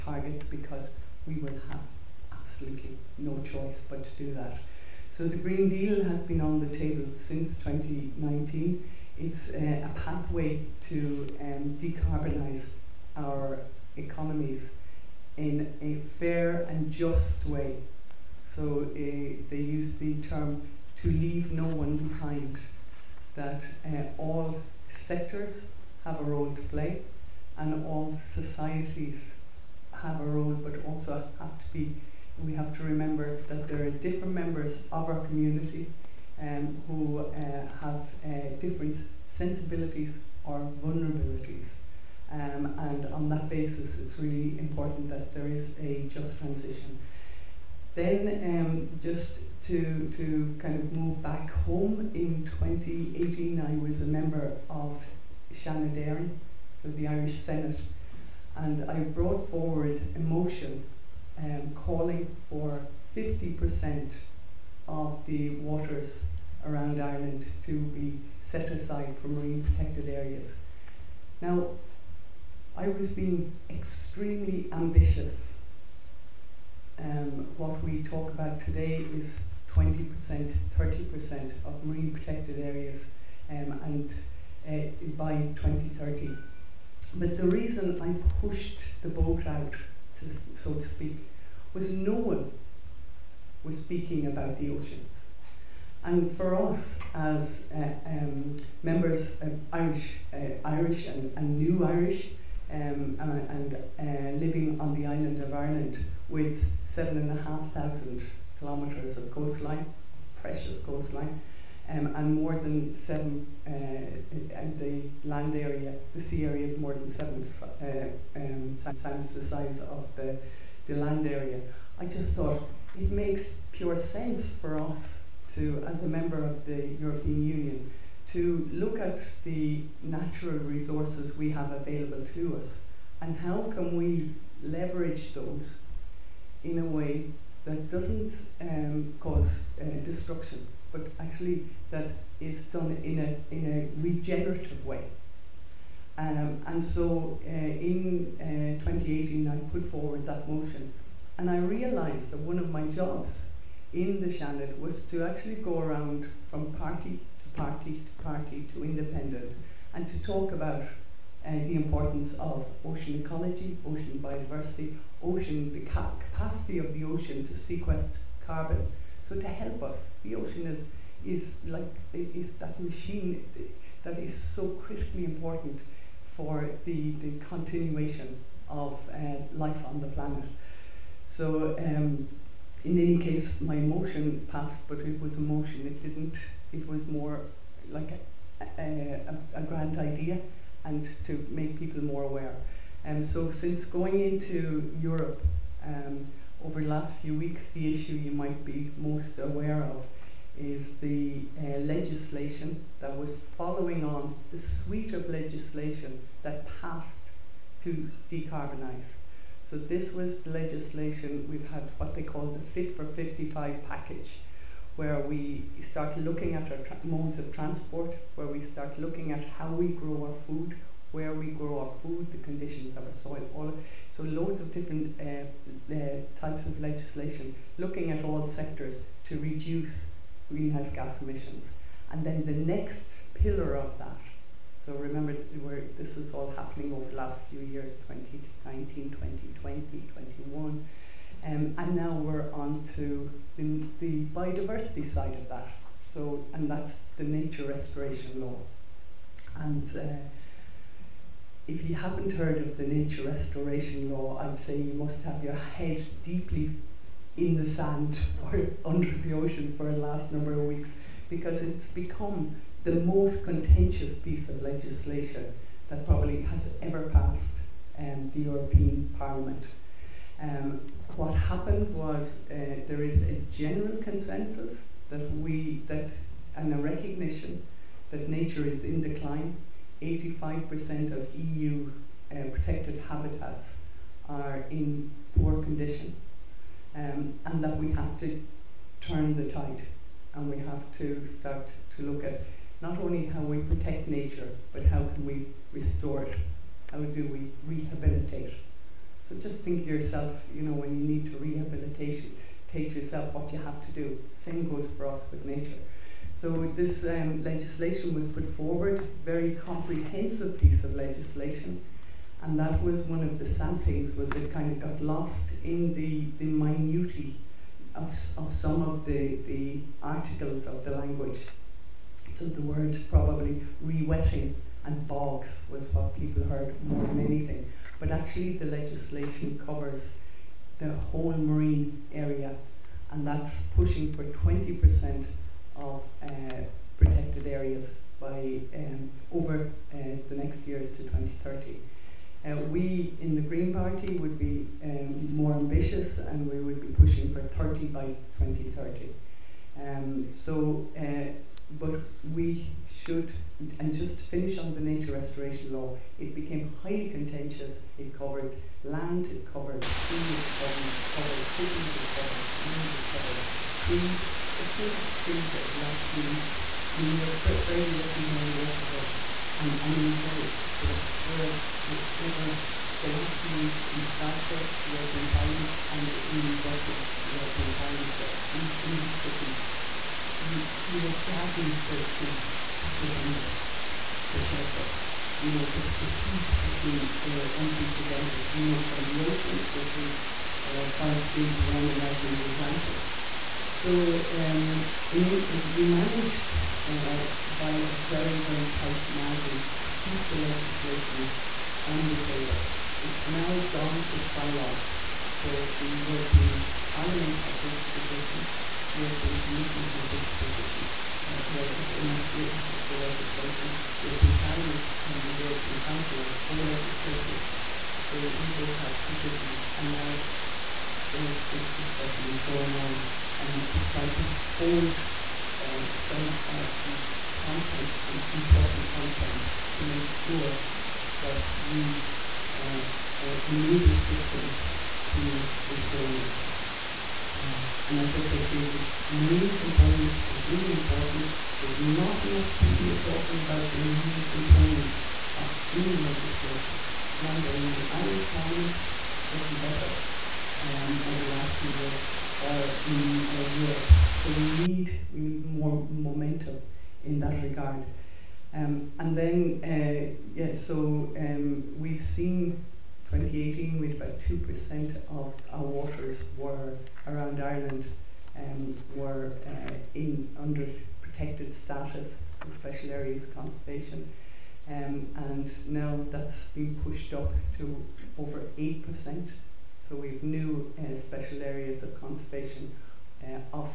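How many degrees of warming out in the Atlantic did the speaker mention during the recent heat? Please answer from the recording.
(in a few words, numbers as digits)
5 degrees.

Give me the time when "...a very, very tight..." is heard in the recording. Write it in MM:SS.
06:37.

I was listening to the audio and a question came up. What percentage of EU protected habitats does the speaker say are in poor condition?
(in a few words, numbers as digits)
85%.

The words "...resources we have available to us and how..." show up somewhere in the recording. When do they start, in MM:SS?
02:10.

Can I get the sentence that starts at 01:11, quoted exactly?
Now, I was being extremely ambitious.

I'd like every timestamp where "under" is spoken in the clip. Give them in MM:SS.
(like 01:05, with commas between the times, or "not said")
04:18, 06:23, 07:50.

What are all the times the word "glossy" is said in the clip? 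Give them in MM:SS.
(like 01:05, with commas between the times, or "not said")
not said.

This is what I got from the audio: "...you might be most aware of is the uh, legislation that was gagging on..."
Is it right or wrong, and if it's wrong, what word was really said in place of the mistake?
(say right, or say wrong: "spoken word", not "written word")
wrong: "following", not "gagging".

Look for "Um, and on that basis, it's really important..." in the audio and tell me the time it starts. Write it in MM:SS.
00:42.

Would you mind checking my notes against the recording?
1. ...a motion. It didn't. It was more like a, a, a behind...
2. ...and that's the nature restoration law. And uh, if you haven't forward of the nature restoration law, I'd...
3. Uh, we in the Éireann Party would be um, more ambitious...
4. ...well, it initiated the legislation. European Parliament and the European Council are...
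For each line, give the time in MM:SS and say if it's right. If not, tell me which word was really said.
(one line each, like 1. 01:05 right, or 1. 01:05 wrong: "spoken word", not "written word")
1. 03:05 wrong: "grand", not "behind"
2. 04:06 wrong: "heard", not "forward"
3. 05:42 wrong: "Green", not "Éireann"
4. 06:51 right.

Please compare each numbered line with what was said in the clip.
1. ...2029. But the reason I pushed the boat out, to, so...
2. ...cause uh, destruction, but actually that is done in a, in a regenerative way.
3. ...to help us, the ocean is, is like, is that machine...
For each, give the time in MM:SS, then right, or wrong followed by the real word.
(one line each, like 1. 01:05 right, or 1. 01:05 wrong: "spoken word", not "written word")
1. 01:25 wrong: "2030", not "2029"
2. 02:19 right
3. 02:49 right.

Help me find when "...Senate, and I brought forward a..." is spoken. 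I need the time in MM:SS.
00:57.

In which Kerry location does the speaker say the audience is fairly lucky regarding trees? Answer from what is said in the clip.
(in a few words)
Waterville.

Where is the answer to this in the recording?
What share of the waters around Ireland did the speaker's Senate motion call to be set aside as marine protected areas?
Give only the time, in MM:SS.
01:03.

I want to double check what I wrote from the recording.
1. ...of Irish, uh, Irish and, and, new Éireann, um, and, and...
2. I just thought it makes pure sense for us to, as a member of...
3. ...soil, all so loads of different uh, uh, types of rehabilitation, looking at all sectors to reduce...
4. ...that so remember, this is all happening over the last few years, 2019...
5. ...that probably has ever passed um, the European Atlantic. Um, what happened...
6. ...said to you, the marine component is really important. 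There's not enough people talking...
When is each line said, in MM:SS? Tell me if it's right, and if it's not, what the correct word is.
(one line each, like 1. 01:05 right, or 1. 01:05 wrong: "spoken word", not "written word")
1. 01:39 wrong: "Irish", not "Éireann"
2. 02:01 right
3. 03:43 wrong: "legislation", not "rehabilitation"
4. 03:53 right
5. 04:25 wrong: "Parliament", not "Atlantic"
6. 07:18 right.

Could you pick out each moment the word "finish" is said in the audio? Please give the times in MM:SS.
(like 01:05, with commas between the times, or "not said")
05:54.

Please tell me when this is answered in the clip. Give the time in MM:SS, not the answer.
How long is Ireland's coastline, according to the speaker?
01:46.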